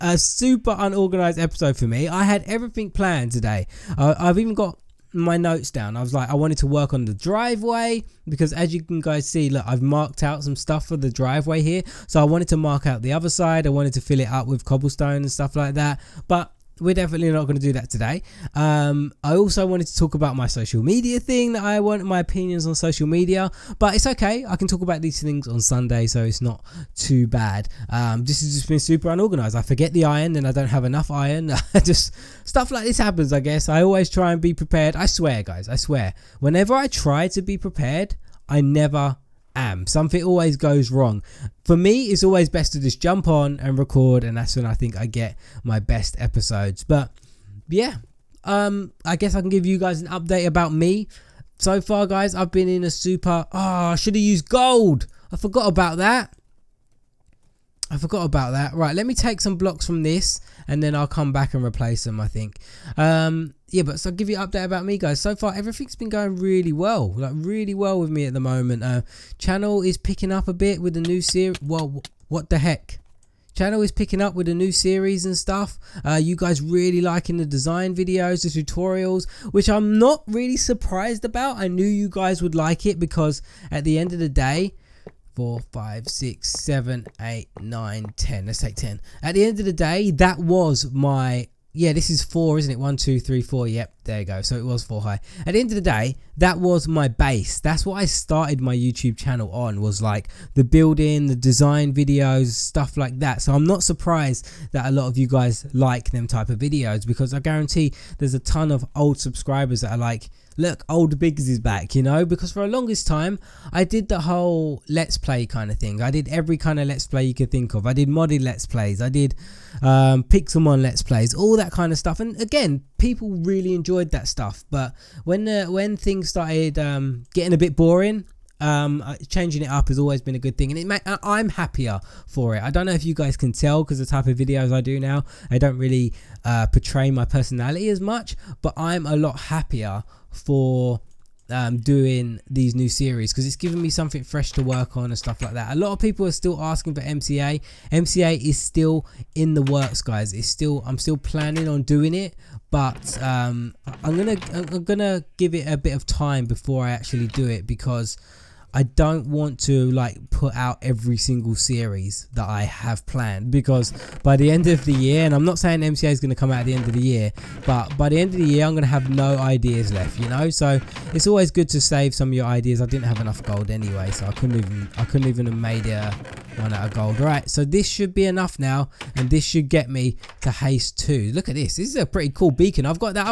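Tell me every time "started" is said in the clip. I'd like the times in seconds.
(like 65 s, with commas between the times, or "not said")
98 s, 126 s.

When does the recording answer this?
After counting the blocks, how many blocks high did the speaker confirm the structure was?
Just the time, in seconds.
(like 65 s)
94 s.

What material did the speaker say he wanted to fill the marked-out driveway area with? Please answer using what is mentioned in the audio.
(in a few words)
cobblestone.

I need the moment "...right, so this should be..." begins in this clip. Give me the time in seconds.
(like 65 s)
177 s.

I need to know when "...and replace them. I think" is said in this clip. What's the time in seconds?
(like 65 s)
61 s.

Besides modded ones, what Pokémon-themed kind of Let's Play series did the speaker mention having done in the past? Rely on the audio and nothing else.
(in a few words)
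Pixelmon.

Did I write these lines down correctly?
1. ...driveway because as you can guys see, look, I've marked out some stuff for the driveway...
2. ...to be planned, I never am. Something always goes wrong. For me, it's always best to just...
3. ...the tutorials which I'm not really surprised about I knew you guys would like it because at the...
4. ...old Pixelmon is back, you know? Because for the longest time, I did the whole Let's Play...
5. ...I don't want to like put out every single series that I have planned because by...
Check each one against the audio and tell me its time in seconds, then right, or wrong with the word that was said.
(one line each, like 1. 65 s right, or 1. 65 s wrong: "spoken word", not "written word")
1. 7 s right
2. 37 s wrong: "prepared", not "planned"
3. 78 s right
4. 110 s wrong: "Biggs", not "Pixelmon"
5. 158 s right.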